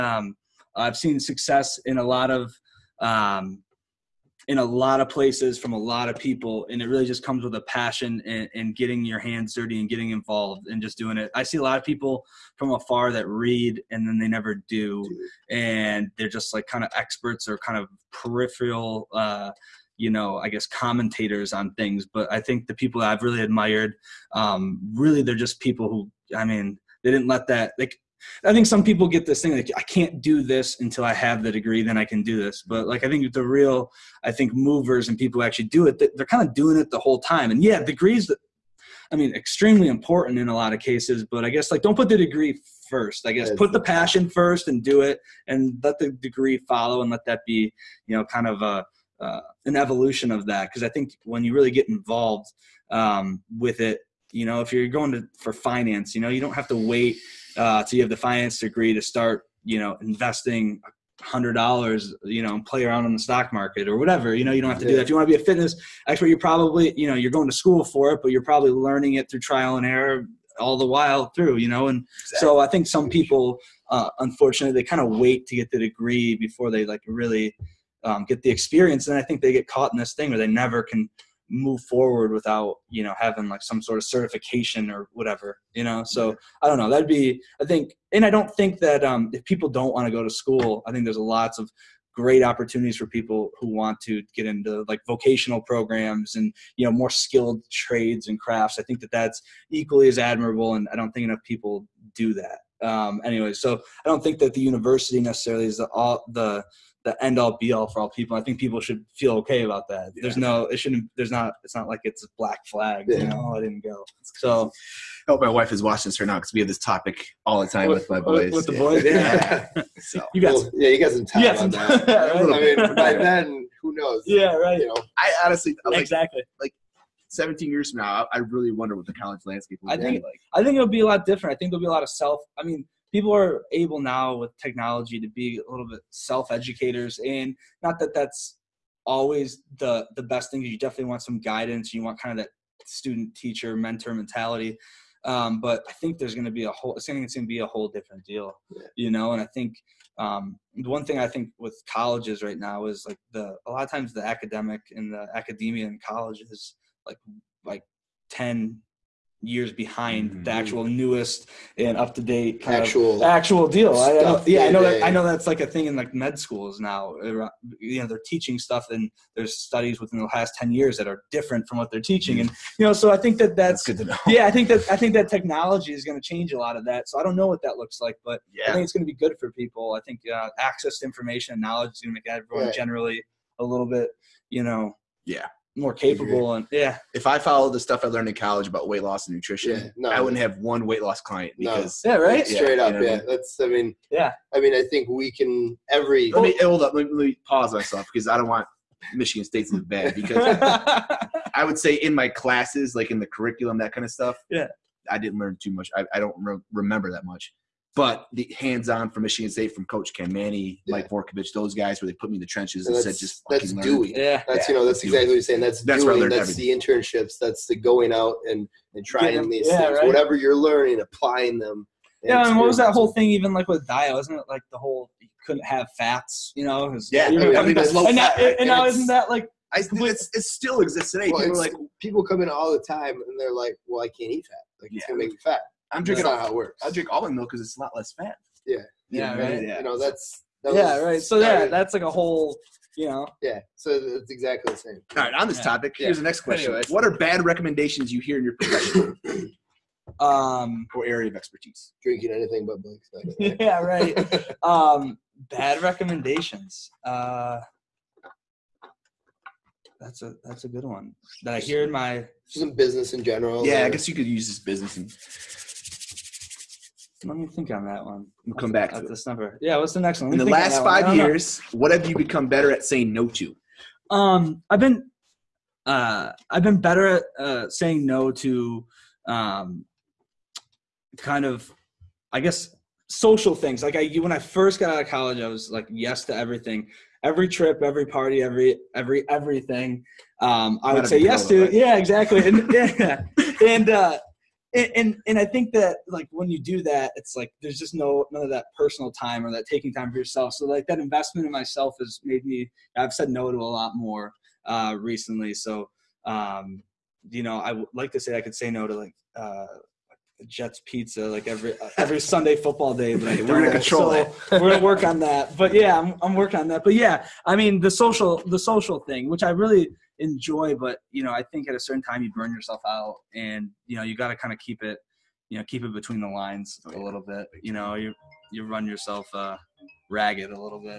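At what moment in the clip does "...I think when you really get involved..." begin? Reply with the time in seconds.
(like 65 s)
50 s.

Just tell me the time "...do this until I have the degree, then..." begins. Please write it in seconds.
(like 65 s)
30 s.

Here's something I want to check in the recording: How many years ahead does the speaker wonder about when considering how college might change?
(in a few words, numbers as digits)
17.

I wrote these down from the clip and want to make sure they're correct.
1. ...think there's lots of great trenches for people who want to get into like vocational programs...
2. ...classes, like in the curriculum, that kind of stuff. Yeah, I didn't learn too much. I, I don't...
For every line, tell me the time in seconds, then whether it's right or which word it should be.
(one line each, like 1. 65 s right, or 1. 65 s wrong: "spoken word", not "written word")
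1. 90 s wrong: "opportunities", not "trenches"
2. 202 s right.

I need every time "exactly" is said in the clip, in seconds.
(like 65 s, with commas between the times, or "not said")
72 s, 125 s, 215 s, 244 s, 291 s.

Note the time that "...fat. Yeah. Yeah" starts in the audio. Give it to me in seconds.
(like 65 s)
238 s.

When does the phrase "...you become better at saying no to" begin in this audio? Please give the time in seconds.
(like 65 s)
272 s.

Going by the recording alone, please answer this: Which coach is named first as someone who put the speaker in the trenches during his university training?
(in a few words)
Ken Mannie.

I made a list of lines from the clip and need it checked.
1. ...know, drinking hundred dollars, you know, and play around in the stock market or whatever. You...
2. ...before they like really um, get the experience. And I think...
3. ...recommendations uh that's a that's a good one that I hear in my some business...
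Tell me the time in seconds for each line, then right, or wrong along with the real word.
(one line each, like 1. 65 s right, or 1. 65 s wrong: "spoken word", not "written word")
1. 59 s wrong: "investing", not "drinking"
2. 76 s right
3. 255 s right.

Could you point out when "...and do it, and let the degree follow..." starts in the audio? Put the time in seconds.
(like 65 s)
44 s.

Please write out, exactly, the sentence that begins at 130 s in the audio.
I think it'll be a lot different.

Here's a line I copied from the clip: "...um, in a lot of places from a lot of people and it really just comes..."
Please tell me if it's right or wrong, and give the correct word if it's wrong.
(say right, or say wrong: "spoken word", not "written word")
right.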